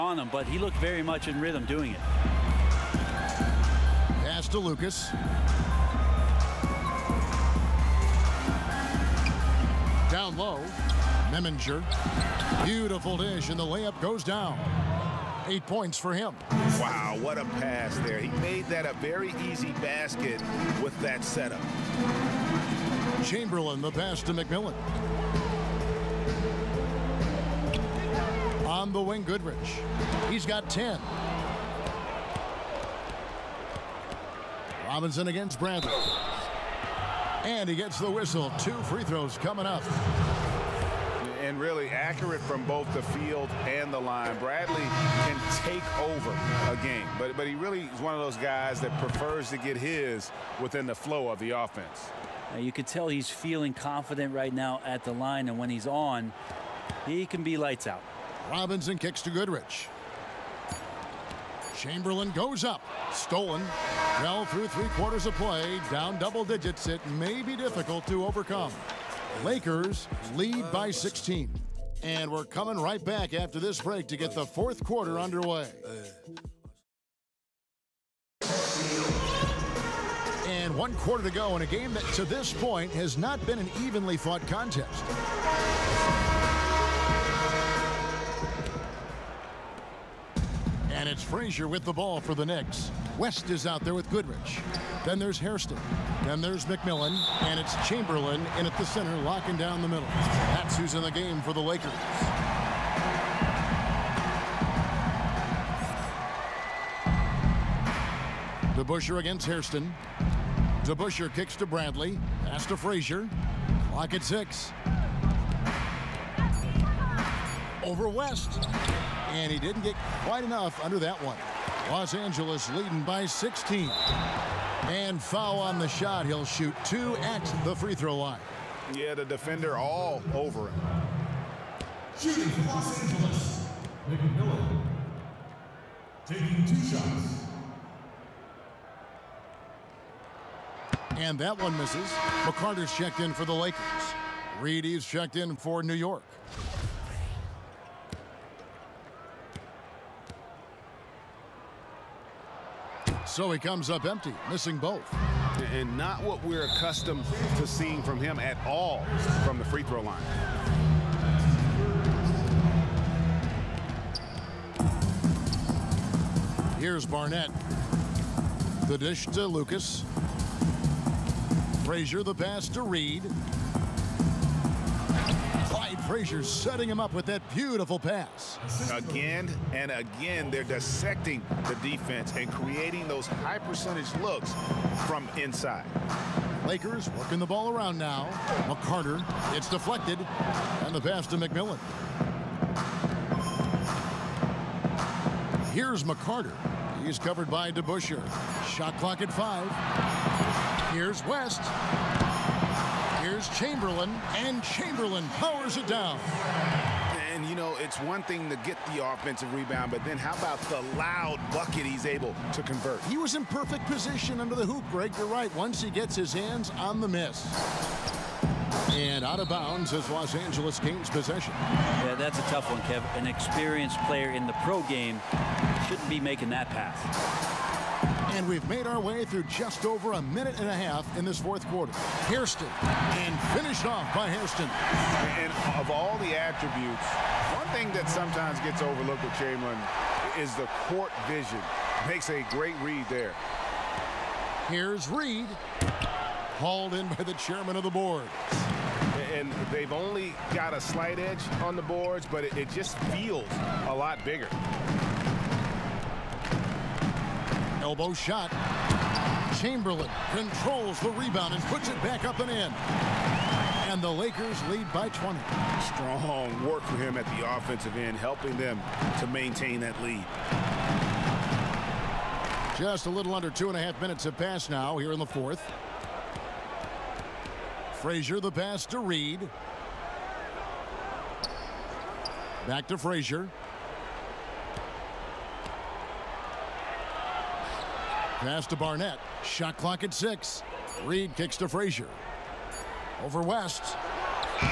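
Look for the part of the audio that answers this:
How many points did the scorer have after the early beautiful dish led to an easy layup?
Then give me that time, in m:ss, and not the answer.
0:15.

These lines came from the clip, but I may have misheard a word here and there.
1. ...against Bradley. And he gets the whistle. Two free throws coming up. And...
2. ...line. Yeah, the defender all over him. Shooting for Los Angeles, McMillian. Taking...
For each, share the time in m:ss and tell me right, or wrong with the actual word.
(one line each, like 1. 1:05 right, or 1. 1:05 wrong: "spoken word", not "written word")
1. 0:35 right
2. 2:08 right.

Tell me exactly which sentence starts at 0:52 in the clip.
Now you could tell he's feeling confident right now at the line, and when he's on, he can be lights out.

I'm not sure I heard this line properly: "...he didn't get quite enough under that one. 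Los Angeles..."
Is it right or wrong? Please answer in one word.
right.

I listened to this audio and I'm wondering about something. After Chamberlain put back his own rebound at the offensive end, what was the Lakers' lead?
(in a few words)
20.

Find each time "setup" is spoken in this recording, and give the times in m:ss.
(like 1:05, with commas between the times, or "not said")
0:21.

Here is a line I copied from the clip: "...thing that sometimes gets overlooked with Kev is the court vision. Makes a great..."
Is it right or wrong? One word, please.
wrong.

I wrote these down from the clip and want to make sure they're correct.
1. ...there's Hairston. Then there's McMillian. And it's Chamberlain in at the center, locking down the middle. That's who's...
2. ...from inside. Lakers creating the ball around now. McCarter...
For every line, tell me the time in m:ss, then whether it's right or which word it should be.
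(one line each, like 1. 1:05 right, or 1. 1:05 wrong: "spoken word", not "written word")
1. 1:35 right
2. 3:05 wrong: "working", not "creating".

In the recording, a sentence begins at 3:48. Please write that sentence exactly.
And we've made our way through just over a minute and a half in this fourth quarter.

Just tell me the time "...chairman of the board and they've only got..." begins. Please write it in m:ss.
4:07.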